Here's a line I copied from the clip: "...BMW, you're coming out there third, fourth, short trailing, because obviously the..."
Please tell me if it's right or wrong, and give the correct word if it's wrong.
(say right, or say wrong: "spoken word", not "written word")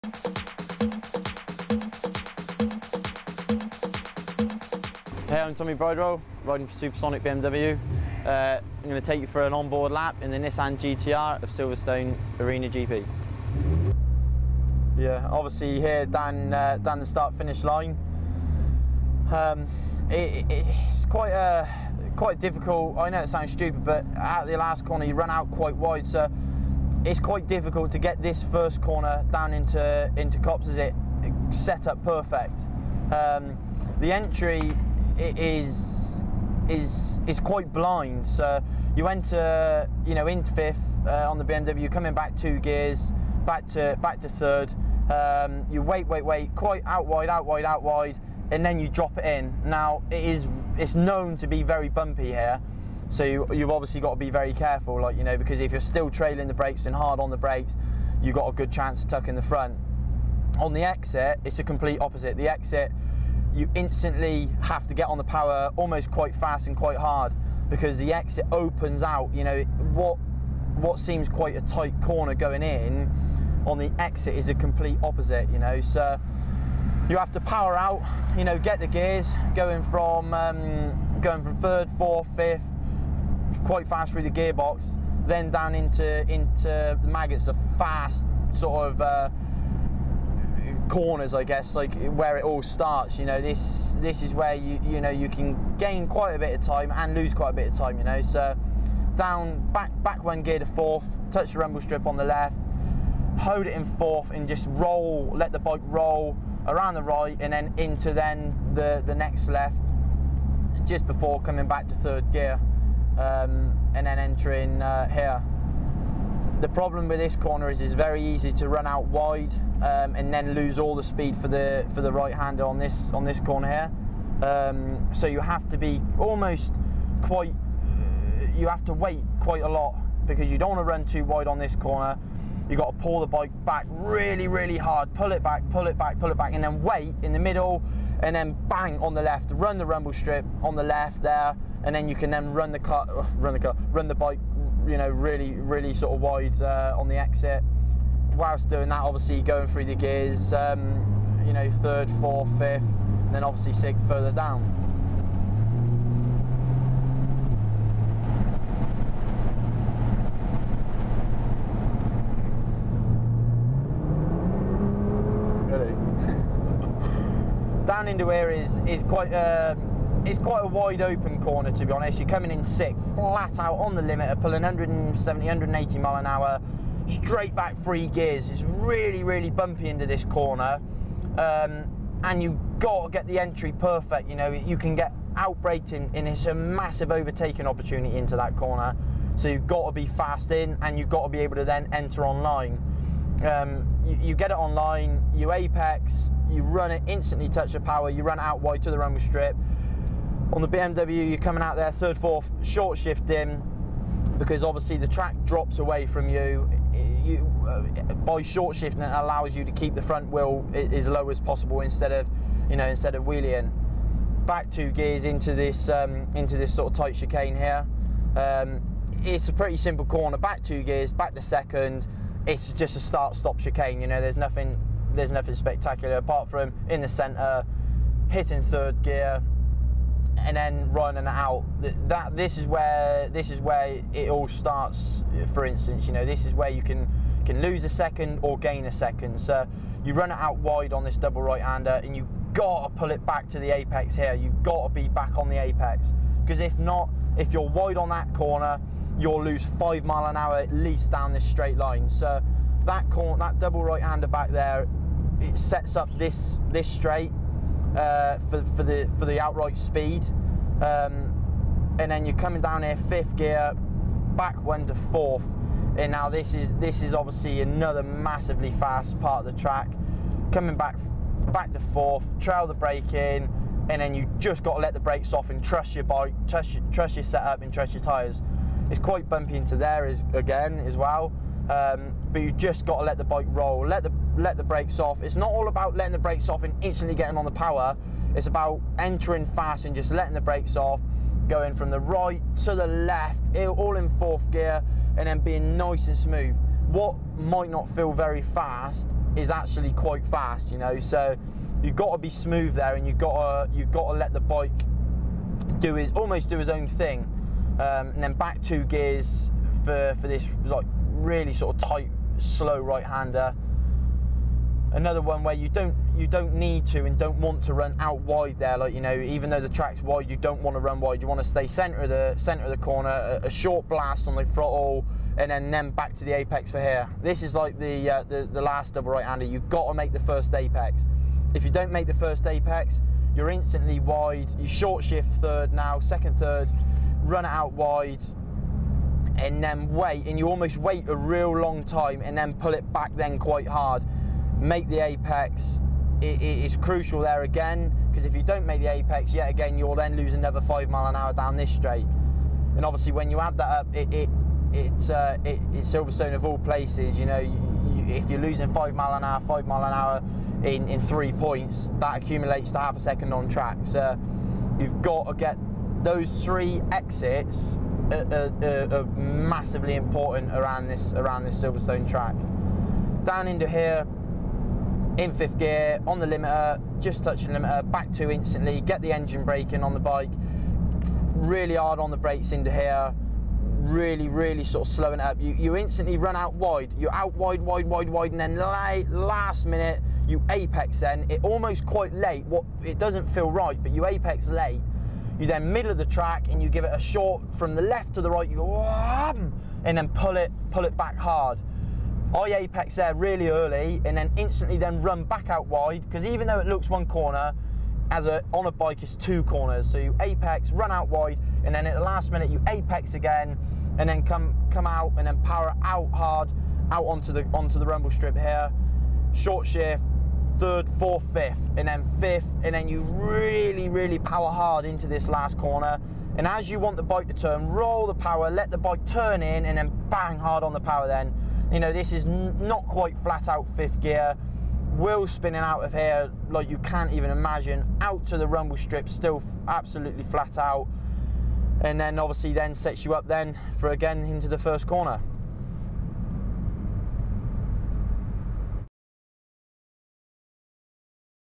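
wrong: "shifting", not "trailing".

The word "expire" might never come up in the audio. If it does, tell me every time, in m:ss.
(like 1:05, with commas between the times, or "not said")
not said.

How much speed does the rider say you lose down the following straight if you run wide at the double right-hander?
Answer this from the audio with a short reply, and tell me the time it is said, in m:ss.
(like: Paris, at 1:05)
5 mph, at 4:09.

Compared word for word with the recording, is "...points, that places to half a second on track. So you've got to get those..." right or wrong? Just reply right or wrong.
wrong.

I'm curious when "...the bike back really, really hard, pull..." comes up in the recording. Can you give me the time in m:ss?
2:13.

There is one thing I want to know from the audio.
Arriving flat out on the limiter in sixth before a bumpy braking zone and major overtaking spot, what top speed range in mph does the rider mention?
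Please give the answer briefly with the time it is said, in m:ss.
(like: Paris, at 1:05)
170-180 mph, at 2:54.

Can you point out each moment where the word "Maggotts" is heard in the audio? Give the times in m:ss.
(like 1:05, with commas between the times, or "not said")
1:27.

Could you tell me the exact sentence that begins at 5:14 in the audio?
Another one where you don't you don't need to and don't want to run out wide there.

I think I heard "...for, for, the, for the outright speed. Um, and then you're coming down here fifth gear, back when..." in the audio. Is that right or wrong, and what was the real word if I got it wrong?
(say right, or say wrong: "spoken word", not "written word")
right.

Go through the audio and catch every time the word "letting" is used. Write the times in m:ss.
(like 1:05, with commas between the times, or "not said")
4:45, 4:50.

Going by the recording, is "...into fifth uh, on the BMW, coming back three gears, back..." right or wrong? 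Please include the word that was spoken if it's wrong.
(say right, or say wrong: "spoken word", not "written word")
wrong: "two", not "three".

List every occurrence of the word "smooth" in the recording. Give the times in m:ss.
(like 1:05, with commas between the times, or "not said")
4:56, 5:02.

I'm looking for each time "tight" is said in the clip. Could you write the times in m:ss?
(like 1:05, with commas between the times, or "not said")
1:11, 3:36, 5:11.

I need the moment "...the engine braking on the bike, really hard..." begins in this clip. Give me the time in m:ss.
6:19.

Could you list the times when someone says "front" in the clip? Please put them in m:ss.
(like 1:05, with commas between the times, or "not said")
0:59, 3:30.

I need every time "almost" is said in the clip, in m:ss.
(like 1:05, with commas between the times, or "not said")
1:05, 2:06, 5:06, 5:40, 6:31.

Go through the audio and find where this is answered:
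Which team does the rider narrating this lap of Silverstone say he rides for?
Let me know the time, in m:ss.
0:06.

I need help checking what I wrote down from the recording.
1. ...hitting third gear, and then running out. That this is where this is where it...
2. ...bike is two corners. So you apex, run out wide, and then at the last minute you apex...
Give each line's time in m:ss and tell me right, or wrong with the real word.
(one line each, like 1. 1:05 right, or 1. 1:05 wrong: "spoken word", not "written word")
1. 3:48 right
2. 6:48 right.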